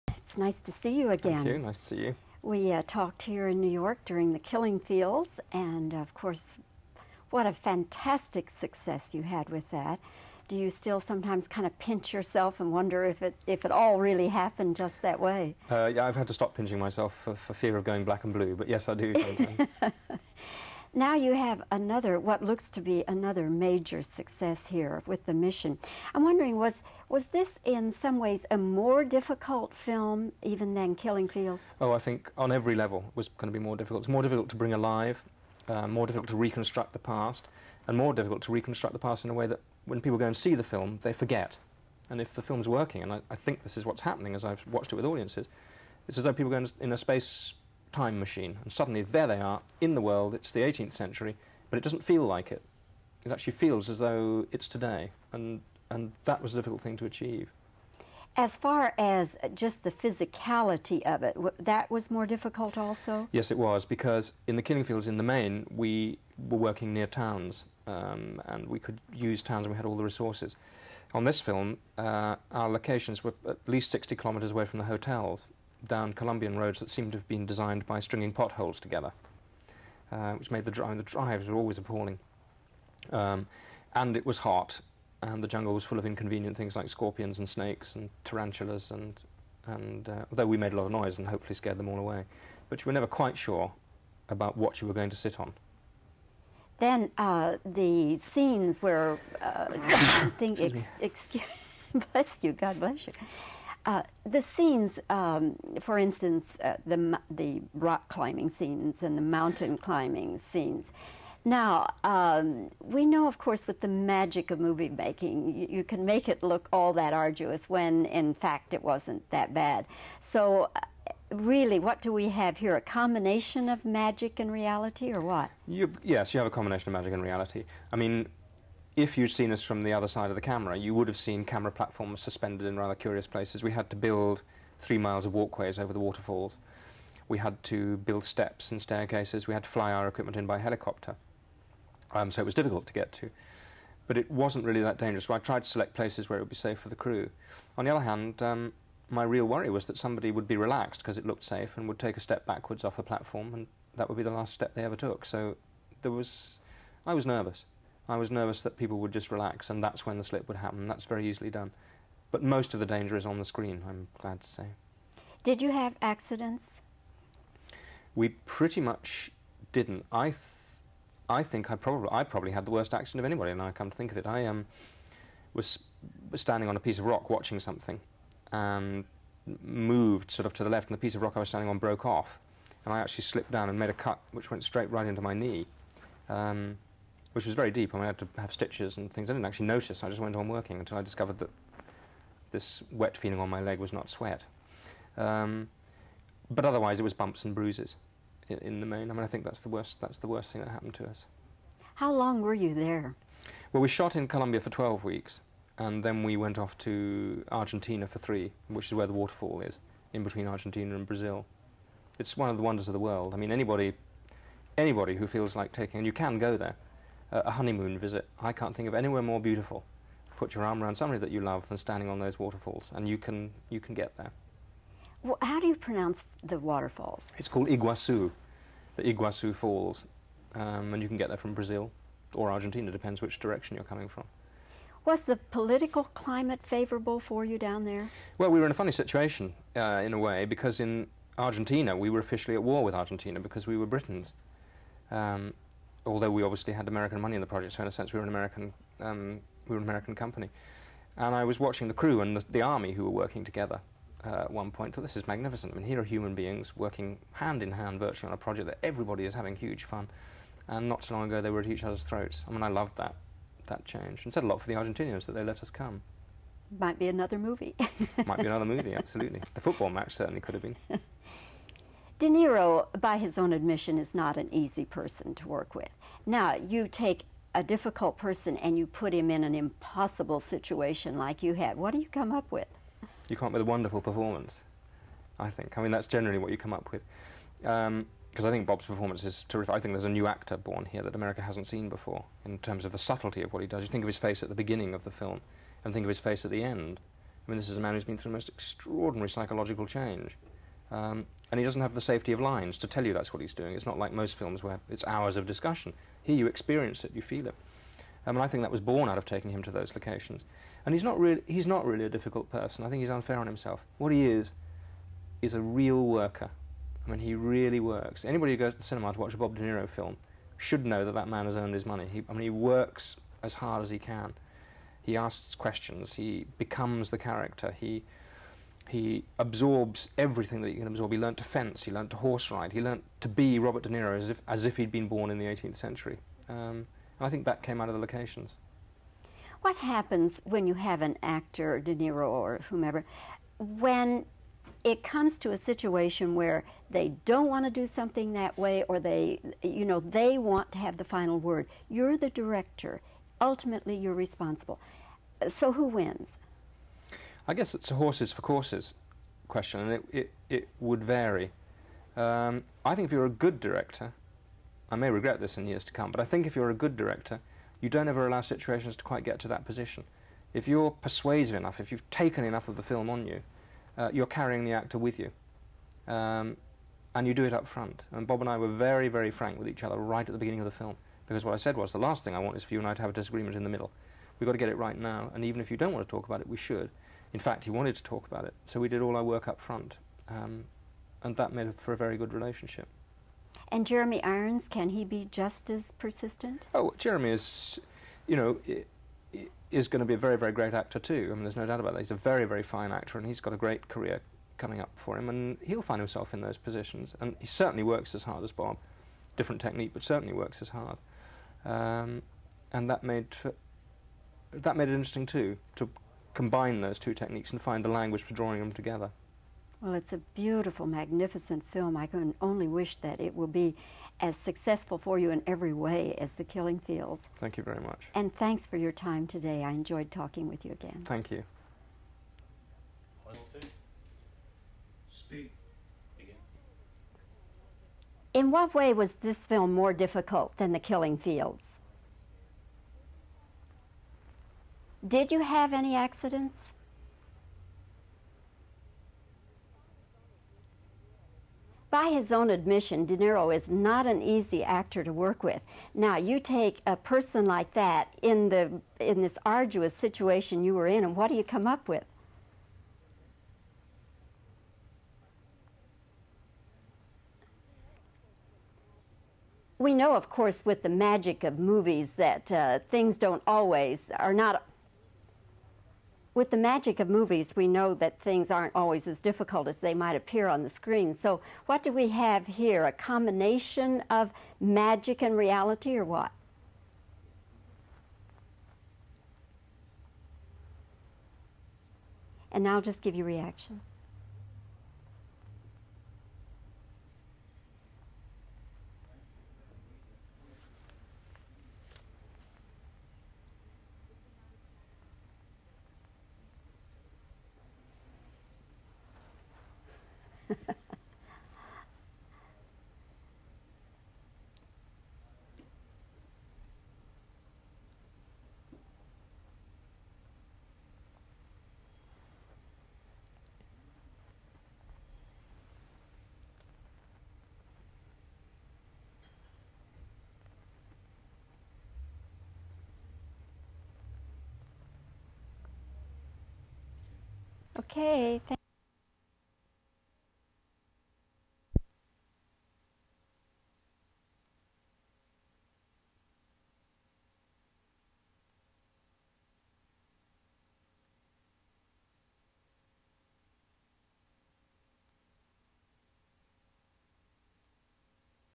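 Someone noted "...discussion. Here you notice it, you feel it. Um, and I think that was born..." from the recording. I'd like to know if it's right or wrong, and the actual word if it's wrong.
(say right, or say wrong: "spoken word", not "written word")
wrong: "experience", not "notice".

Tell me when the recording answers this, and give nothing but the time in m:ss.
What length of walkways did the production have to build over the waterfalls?
2:14.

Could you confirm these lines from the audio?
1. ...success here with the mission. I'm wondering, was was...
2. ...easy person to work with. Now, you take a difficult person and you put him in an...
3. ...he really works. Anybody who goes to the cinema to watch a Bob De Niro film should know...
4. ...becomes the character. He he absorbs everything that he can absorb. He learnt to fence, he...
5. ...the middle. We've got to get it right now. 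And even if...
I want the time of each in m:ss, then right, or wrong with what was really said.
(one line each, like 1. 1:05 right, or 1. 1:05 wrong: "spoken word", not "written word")
1. 0:24 right
2. 4:34 right
3. 5:17 right
4. 5:26 right
5. 6:23 right.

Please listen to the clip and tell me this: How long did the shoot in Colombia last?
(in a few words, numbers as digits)
12 weeks.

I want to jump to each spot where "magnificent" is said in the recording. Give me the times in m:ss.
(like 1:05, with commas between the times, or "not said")
4:15, 7:00.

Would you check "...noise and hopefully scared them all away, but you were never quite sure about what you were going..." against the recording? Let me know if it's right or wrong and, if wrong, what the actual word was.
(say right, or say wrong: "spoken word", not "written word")
right.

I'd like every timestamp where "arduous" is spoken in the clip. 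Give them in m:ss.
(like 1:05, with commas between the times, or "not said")
1:57, 7:39.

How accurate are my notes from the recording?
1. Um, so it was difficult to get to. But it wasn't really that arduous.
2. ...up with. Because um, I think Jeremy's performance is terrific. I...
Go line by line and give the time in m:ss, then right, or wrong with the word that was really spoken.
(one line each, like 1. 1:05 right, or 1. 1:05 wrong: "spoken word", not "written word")
1. 2:22 wrong: "dangerous", not "arduous"
2. 4:46 wrong: "Bob", not "Jeremy".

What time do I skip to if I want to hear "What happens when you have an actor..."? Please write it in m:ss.
5:39.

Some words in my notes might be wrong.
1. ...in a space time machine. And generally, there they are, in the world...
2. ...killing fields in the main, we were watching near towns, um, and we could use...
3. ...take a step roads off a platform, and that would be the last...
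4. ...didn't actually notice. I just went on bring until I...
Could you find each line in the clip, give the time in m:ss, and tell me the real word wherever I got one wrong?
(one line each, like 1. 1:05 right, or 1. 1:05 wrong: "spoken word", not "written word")
1. 0:46 wrong: "suddenly", not "generally"
2. 1:04 wrong: "working", not "watching"
3. 2:31 wrong: "backwards", not "roads"
4. 3:09 wrong: "working", not "bring".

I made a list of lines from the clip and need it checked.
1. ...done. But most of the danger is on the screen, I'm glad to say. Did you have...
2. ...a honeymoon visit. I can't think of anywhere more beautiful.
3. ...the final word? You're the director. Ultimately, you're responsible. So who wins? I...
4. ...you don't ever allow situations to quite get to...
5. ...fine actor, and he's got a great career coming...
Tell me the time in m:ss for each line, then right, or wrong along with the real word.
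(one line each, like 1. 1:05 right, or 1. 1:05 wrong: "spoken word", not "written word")
1. 2:41 right
2. 3:37 right
3. 5:50 right
4. 6:07 right
5. 6:42 right.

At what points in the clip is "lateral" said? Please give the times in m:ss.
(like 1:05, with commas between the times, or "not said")
not said.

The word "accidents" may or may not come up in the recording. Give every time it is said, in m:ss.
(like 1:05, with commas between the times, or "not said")
2:46, 2:52, 7:25.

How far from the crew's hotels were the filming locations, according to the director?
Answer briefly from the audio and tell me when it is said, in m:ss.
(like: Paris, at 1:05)
60 kilometres, at 1:13.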